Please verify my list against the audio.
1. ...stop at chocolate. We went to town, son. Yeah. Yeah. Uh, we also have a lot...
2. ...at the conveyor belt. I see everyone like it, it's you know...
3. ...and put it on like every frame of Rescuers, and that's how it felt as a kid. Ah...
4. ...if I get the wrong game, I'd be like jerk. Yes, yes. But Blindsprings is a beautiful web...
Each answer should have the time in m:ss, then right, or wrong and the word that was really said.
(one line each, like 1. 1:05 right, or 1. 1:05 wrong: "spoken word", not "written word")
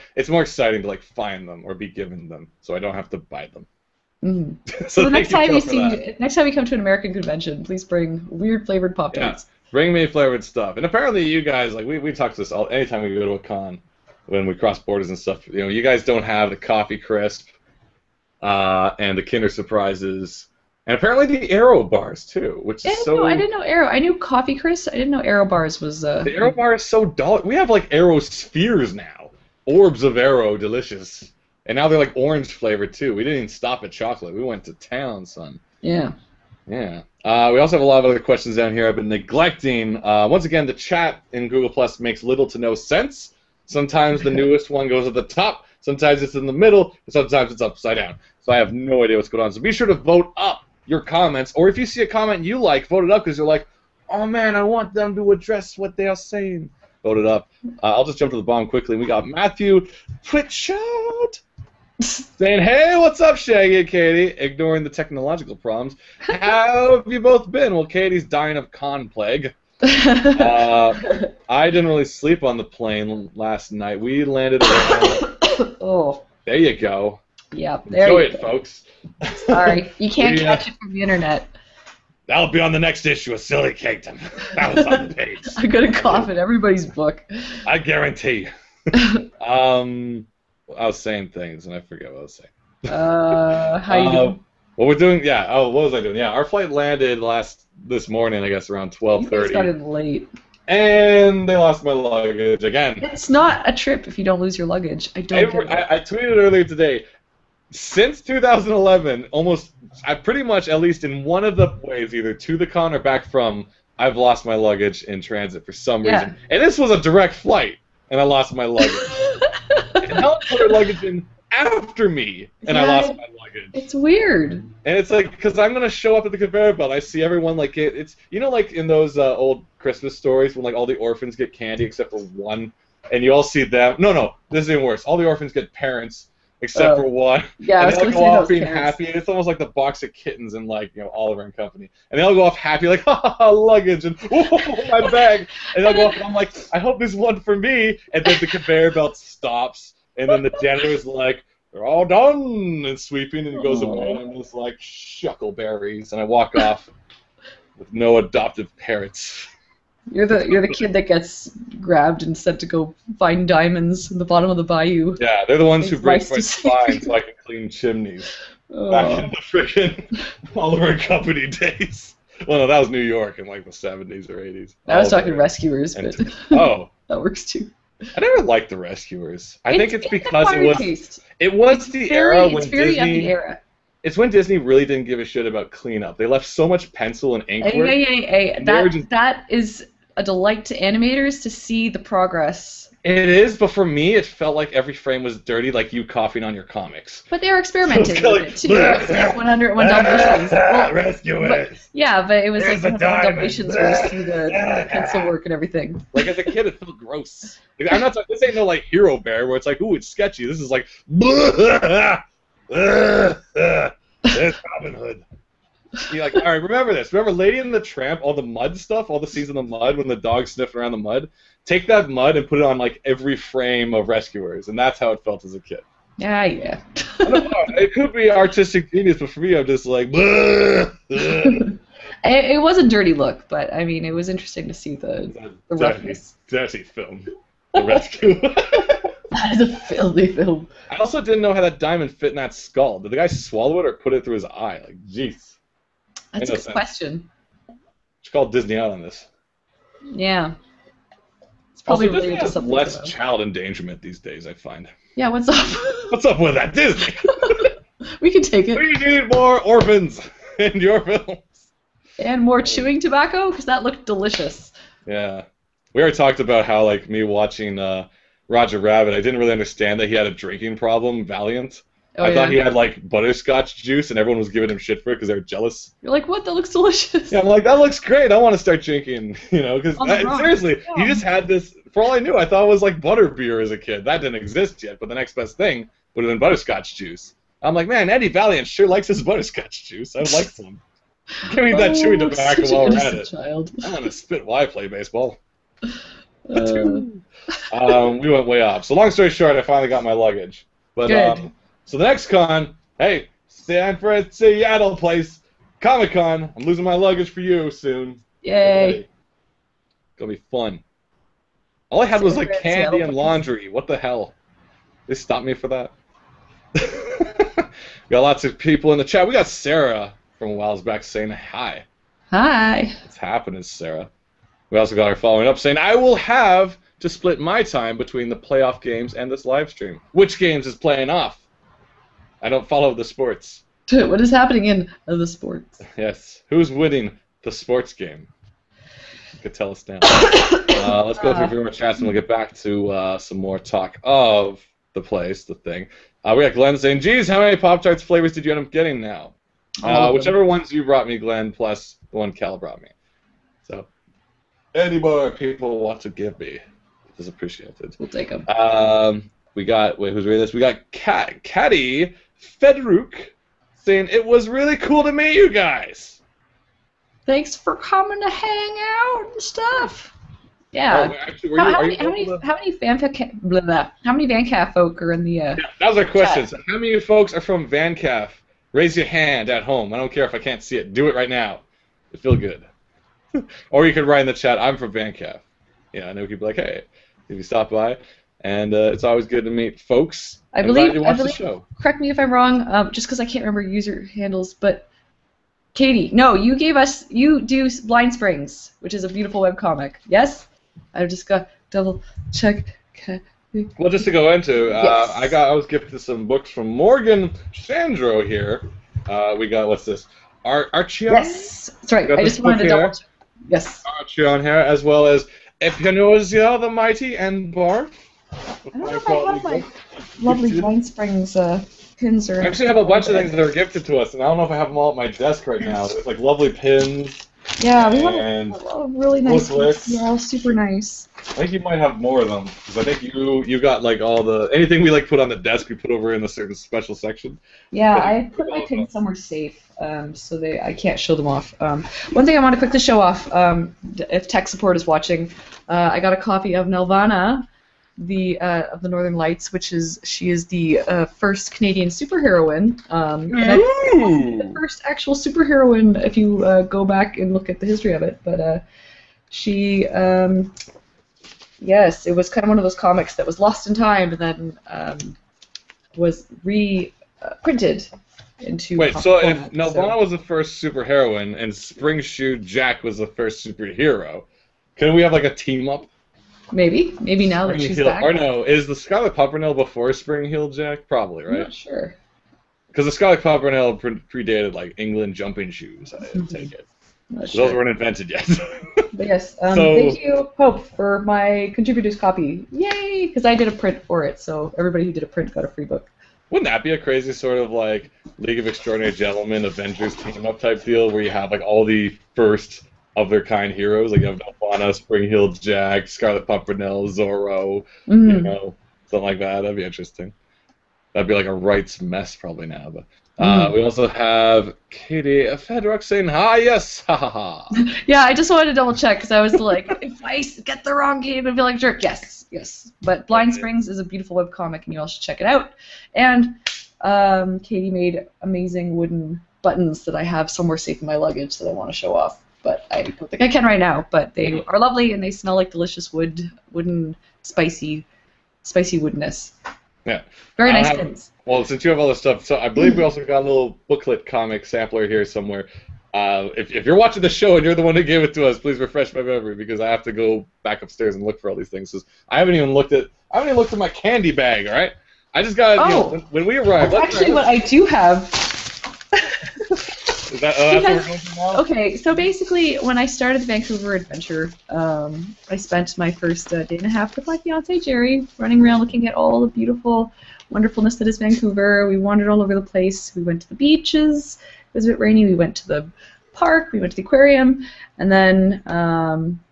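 1. 0:33 right
2. 2:06 right
3. 3:42 right
4. 8:39 right.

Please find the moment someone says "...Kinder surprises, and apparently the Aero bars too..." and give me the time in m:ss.
0:19.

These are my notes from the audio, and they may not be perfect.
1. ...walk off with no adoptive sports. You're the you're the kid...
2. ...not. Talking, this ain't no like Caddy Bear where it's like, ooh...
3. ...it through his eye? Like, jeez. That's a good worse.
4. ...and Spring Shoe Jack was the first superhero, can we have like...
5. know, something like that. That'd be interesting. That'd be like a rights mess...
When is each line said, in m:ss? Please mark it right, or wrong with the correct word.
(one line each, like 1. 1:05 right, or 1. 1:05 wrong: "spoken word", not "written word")
1. 2:36 wrong: "parents", not "sports"
2. 3:28 wrong: "Hero", not "Caddy"
3. 4:04 wrong: "sense", not "worse"
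4. 7:51 right
5. 8:28 right.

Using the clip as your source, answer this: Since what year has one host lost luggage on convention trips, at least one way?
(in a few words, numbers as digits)
2011.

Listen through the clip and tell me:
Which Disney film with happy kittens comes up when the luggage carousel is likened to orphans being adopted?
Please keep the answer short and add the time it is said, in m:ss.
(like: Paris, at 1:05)
Oliver and Company, at 2:21.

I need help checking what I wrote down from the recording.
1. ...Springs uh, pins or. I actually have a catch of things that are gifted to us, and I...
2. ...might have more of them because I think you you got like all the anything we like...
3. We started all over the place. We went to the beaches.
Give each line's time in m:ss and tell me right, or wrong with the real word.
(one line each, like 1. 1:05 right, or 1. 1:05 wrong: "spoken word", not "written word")
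1. 7:00 wrong: "bunch", not "catch"
2. 7:11 right
3. 9:31 wrong: "wandered", not "started".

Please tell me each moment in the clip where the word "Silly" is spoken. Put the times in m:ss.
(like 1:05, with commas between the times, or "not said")
1:23.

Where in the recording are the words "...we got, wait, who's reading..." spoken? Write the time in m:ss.
5:59.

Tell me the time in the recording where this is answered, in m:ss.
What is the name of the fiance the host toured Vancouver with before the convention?
9:27.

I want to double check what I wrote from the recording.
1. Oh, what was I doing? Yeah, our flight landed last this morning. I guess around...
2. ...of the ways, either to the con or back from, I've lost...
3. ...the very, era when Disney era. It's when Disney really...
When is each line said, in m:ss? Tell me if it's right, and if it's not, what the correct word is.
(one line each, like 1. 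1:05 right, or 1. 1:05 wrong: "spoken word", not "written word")
1. 1:35 right
2. 1:51 right
3. 3:01 right.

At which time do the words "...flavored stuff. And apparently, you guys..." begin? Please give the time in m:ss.
0:10.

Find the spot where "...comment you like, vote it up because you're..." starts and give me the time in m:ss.
0:52.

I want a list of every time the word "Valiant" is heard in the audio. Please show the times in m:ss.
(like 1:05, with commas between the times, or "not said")
4:31, 4:48.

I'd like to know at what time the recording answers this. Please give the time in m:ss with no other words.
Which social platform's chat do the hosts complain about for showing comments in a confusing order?
0:41.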